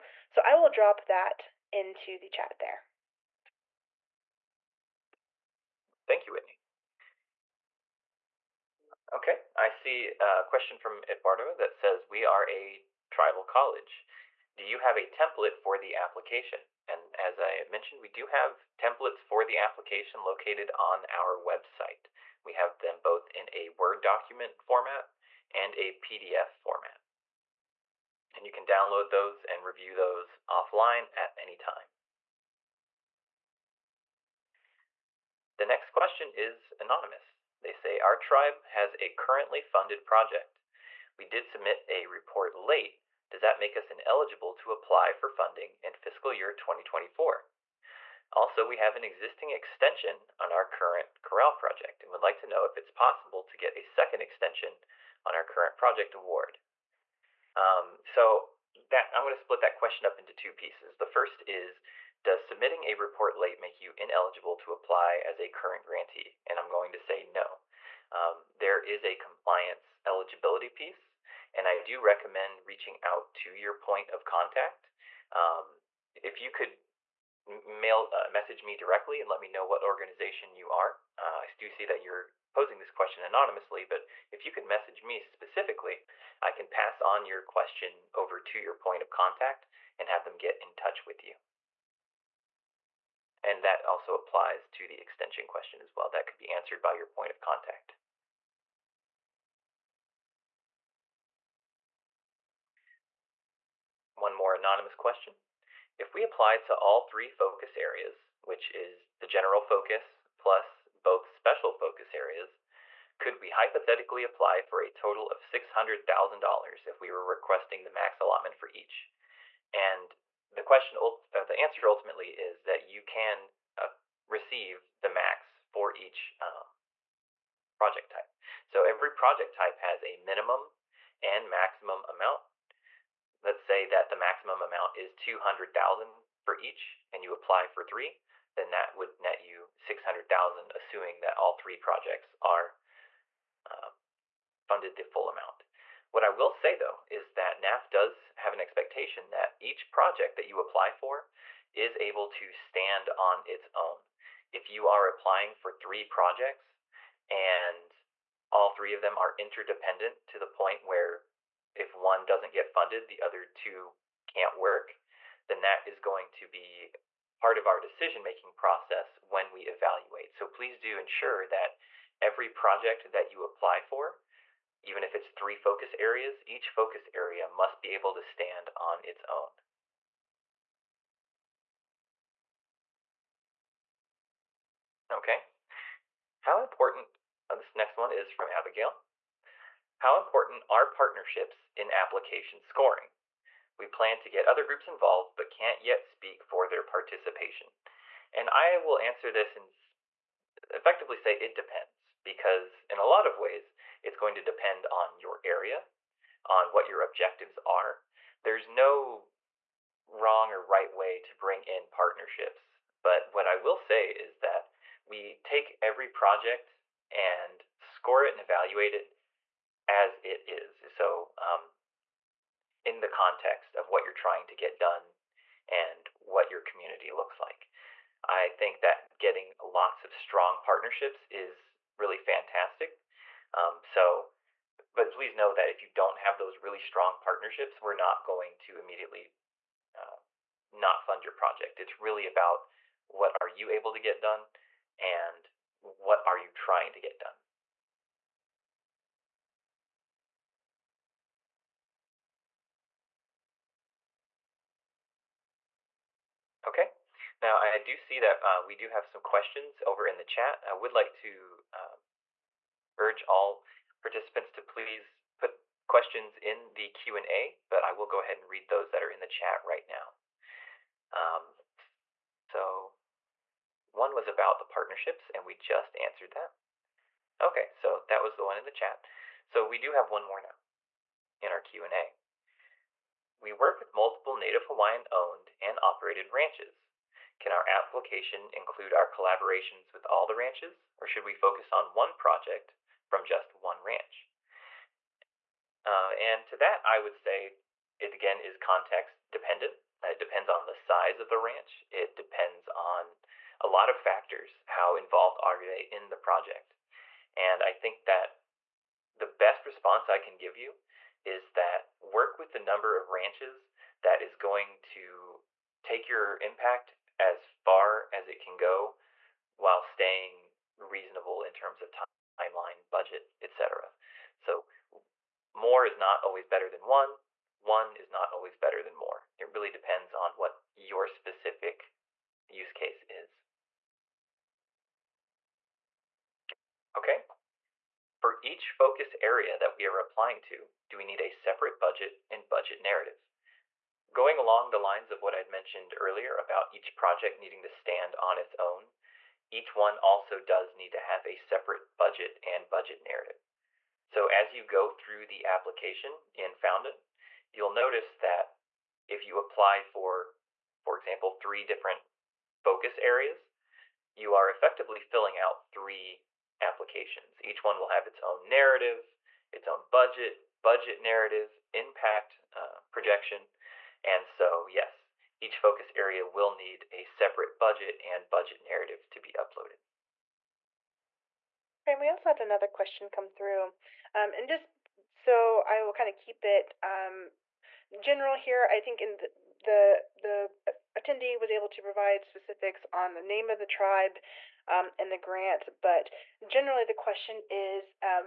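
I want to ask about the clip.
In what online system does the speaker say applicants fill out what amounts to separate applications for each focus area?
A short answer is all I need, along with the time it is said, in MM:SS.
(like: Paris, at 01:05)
Foundant, at 05:56.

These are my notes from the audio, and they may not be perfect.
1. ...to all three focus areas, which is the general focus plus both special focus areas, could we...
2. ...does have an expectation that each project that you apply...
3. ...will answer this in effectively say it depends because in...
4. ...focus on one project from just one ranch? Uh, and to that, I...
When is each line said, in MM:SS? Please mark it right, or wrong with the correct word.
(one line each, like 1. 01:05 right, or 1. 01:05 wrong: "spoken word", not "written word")
1. 01:46 right
2. 02:27 right
3. 03:18 right
4. 04:51 right.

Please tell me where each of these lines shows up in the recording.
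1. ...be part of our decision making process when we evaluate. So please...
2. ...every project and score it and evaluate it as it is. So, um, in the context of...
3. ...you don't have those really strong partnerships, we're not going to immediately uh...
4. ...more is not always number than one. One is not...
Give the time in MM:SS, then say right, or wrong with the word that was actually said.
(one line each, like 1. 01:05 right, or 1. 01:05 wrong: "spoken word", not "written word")
1. 02:46 right
2. 03:35 right
3. 03:55 right
4. 05:25 wrong: "better", not "number".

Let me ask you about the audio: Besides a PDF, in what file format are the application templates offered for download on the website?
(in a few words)
Word document.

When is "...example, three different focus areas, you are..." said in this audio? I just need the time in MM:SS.
06:00.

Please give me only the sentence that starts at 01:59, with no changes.
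And the question, uh, the answer ultimately is that you can uh, receive the max for each um, project type.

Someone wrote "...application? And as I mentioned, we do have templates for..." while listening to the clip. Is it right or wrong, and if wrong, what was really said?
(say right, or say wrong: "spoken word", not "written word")
right.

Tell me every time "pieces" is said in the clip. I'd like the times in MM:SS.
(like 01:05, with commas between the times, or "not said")
01:00, 01:10.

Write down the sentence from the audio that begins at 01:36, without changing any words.
That could be answered by your point of contact.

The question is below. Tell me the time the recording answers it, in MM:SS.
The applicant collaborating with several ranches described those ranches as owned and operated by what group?
04:44.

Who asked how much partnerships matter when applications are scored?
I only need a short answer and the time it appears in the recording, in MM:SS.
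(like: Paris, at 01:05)
Abigail, at 03:08.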